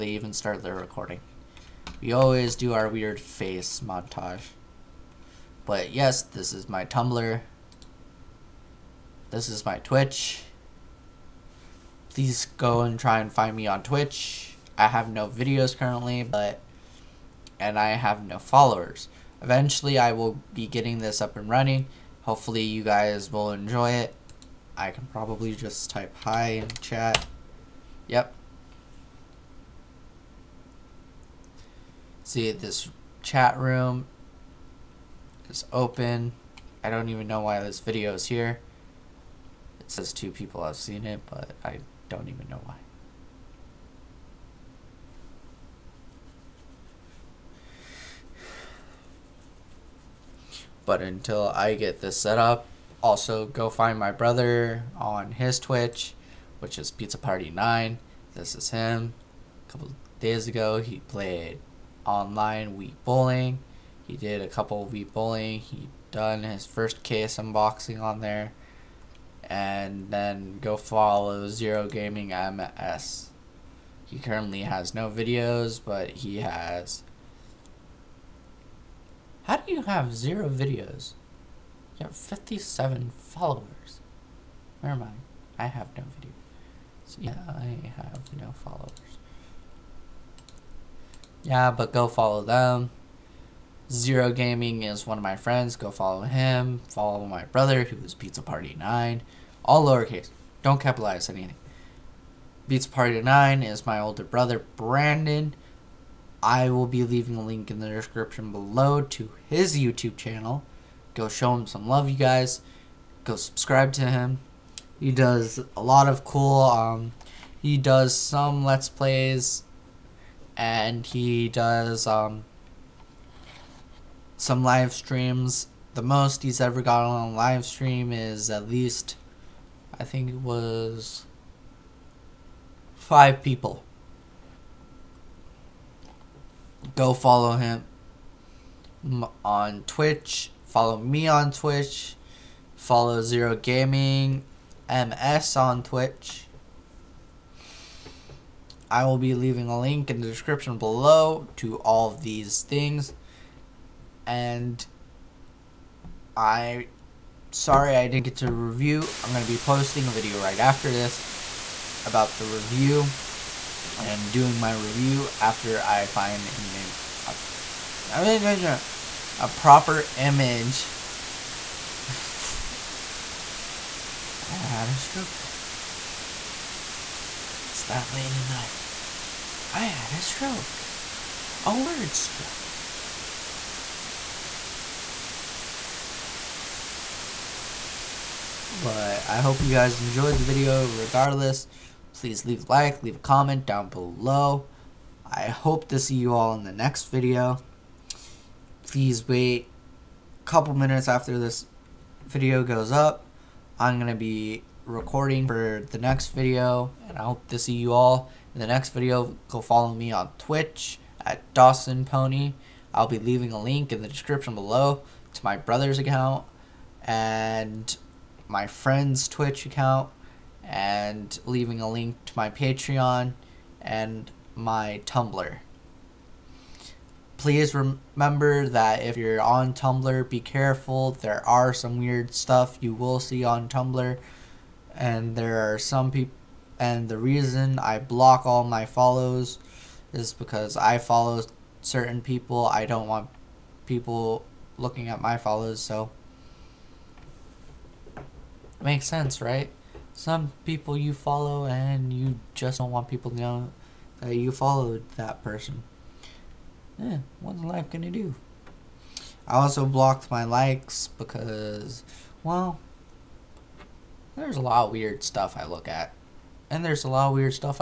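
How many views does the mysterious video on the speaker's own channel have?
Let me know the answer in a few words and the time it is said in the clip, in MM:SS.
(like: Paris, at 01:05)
2, at 00:40.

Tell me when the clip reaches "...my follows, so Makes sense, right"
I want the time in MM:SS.
04:05.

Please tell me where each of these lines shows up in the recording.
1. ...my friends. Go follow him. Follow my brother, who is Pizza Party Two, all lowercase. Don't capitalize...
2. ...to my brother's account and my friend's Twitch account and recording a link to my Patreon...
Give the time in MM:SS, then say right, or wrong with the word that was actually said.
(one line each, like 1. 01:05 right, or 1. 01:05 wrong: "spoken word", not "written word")
1. 01:35 wrong: "Nine", not "Two"
2. 03:35 wrong: "leaving", not "recording".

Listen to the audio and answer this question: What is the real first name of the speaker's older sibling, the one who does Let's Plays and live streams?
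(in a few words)
Brandon.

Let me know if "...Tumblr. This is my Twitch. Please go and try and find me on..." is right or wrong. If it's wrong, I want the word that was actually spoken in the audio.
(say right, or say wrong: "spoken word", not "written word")
right.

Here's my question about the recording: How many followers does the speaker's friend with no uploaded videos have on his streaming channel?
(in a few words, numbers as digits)
57.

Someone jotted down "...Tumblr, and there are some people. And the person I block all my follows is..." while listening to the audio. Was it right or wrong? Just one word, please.
wrong.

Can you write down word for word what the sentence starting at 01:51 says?
Go show him some love, you guys.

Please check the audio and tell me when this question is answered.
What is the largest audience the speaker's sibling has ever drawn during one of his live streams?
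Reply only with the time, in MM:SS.
02:12.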